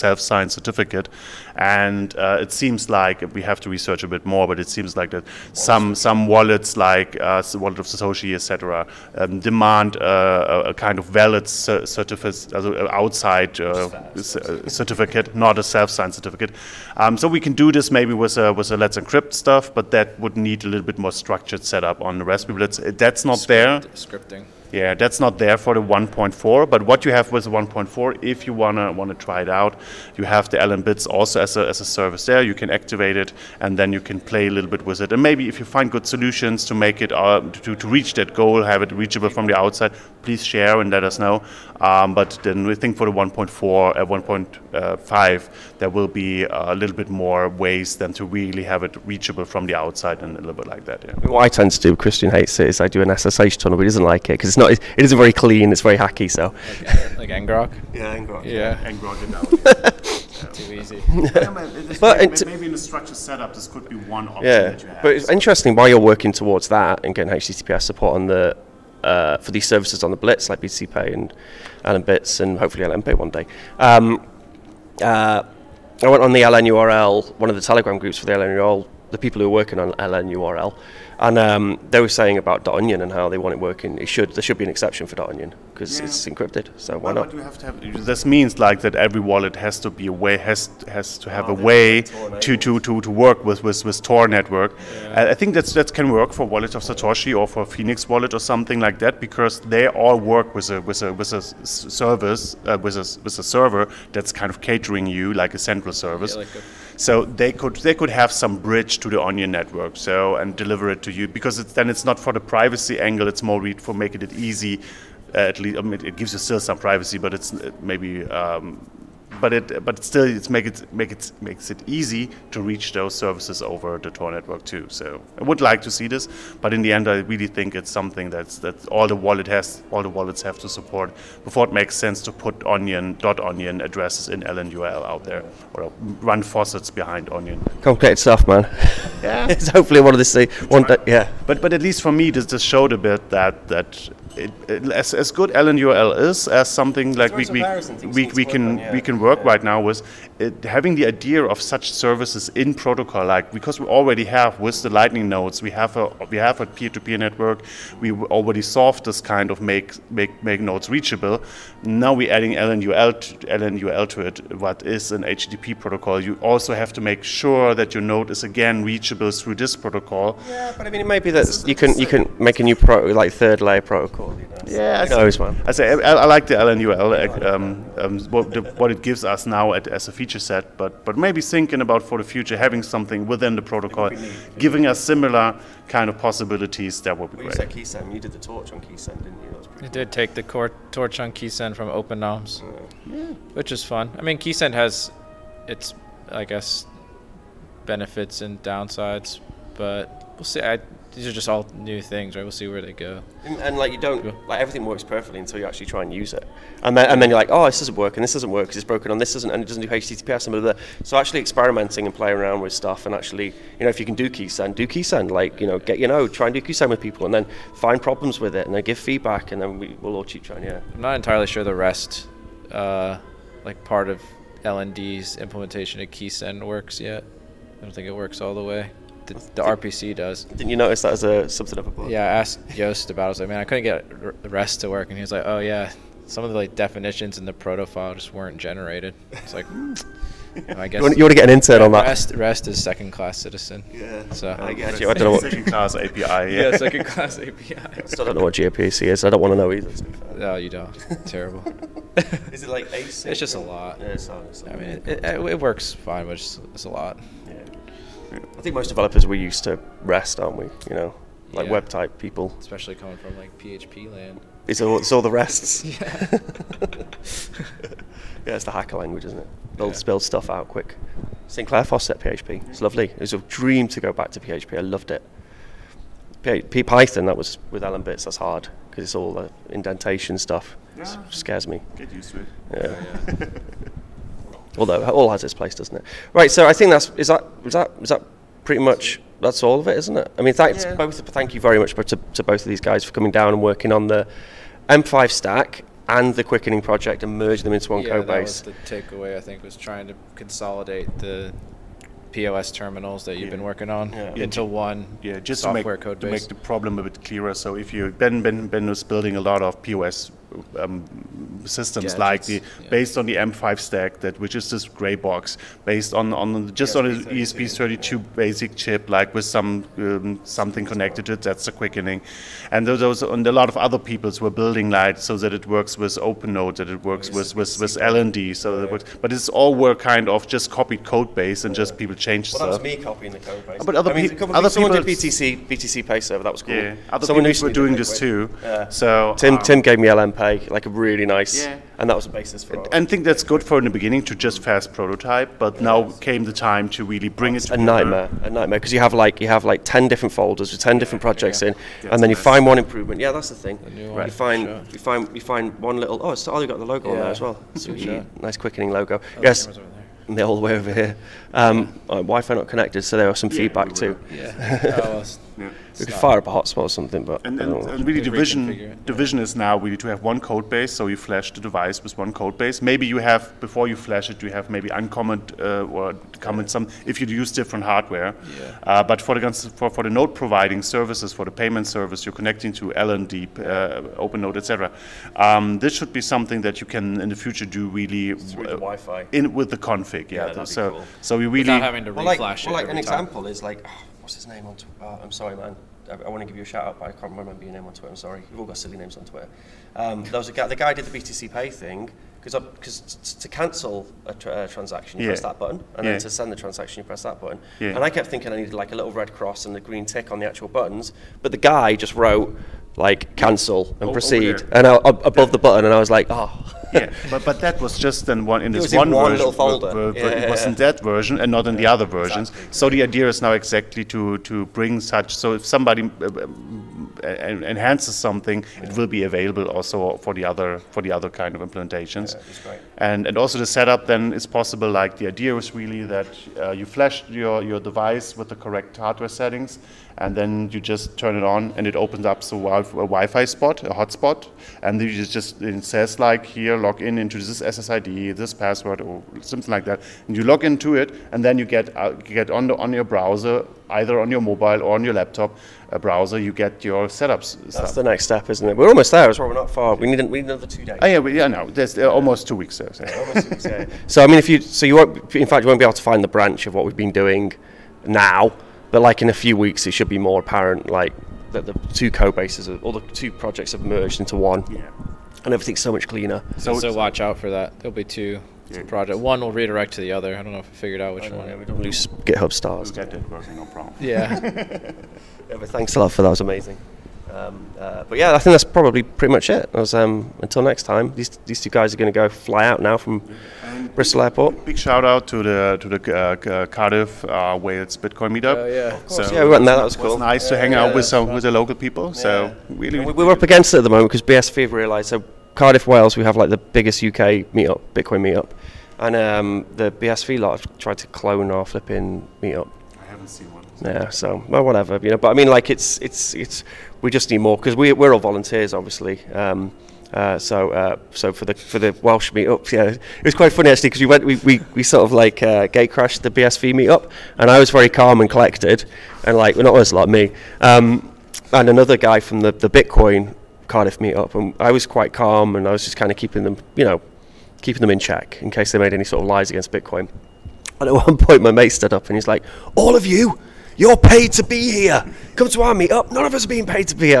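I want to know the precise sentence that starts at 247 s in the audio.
I still don't know what gRPC is.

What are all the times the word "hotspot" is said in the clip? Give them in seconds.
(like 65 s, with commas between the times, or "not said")
366 s, 443 s.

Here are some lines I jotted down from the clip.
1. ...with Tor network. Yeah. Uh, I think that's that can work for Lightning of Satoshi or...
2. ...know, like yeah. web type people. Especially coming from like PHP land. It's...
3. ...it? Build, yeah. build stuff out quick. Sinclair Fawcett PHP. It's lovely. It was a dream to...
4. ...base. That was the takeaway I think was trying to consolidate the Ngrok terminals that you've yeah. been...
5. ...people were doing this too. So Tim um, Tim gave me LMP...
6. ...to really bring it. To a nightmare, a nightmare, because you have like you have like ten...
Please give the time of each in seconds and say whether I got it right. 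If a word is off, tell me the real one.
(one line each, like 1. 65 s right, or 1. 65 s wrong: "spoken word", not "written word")
1. 93 s wrong: "Wallet", not "Lightning"
2. 260 s right
3. 269 s right
4. 298 s wrong: "POS", not "Ngrok"
5. 337 s right
6. 346 s right.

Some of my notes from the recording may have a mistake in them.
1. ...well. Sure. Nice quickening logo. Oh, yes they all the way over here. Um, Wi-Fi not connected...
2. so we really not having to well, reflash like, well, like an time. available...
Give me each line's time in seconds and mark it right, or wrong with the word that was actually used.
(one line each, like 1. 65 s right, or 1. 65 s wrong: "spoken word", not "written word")
1. 357 s right
2. 391 s wrong: "example", not "available".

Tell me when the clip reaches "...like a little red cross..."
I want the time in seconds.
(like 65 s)
408 s.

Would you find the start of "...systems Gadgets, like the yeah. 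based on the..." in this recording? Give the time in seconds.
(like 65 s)
311 s.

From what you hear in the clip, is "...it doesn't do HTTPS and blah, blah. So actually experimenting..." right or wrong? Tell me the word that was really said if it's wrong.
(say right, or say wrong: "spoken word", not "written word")
right.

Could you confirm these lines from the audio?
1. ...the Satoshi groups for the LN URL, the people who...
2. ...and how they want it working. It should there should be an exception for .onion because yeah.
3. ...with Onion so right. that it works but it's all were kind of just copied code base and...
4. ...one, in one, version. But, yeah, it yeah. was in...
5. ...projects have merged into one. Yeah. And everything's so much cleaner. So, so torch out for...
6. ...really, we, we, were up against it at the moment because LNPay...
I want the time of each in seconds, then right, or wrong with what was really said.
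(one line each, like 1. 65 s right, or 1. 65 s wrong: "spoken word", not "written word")
1. 77 s wrong: "Telegram", not "Satoshi"
2. 83 s right
3. 327 s wrong: "LND", not "Onion"
4. 418 s right
5. 473 s wrong: "watch", not "torch"
6. 502 s wrong: "BSV", not "LNPay".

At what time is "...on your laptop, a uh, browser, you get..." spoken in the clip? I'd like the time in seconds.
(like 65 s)
454 s.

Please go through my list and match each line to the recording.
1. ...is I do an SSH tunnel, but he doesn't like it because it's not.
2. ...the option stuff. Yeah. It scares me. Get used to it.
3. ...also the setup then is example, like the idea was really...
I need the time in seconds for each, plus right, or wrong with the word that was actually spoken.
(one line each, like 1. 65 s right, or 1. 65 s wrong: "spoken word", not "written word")
1. 52 s right
2. 279 s wrong: "indentation", not "option"
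3. 433 s wrong: "possible", not "example".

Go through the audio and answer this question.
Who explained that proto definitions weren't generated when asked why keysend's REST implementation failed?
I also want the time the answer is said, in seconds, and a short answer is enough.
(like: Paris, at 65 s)
Joost, at 232 s.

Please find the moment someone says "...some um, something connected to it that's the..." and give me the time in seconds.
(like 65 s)
319 s.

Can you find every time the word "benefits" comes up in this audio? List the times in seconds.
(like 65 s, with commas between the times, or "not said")
197 s.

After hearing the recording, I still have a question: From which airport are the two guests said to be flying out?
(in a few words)
Bristol Airport.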